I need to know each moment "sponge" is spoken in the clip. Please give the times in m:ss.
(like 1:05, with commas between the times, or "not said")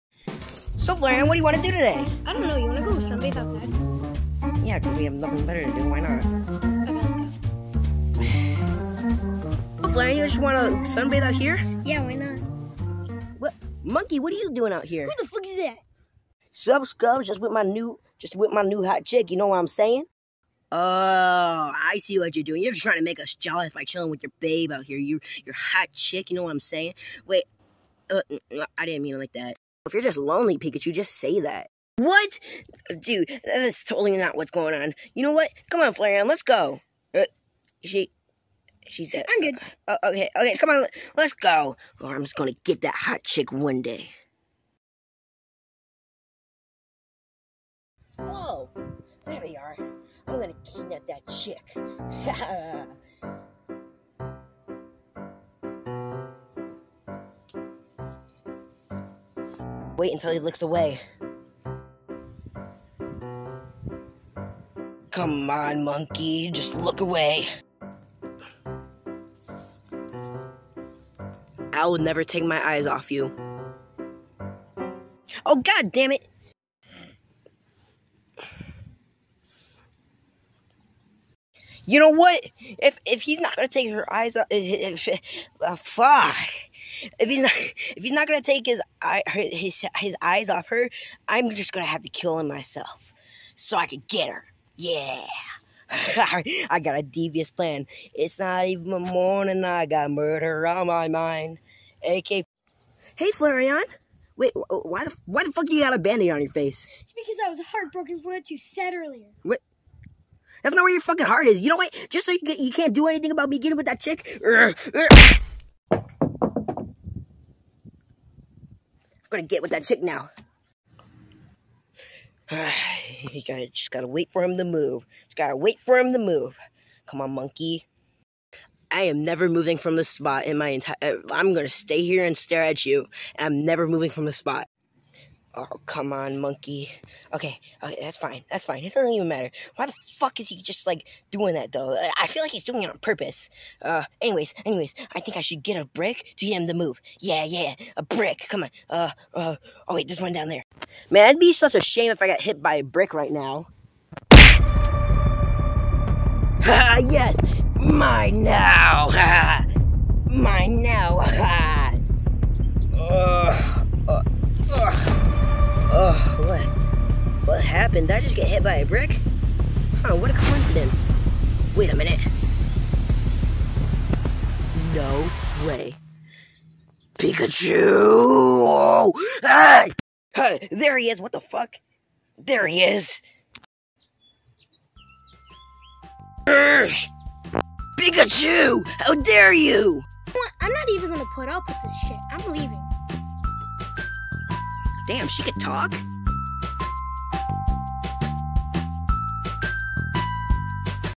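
not said.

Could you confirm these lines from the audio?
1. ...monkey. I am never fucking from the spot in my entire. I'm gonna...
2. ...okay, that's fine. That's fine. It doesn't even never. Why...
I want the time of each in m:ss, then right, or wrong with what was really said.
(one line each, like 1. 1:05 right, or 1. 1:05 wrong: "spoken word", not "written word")
1. 2:07 wrong: "moving", not "fucking"
2. 2:17 wrong: "matter", not "never".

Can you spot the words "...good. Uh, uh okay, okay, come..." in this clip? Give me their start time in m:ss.
0:39.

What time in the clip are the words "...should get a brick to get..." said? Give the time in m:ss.
2:25.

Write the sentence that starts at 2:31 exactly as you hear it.
Man, it'd be such a shame if I got hit by a brick right now.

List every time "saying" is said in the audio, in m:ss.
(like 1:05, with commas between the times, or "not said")
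0:19, 0:26.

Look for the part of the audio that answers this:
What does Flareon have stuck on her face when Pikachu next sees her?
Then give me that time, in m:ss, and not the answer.
1:45.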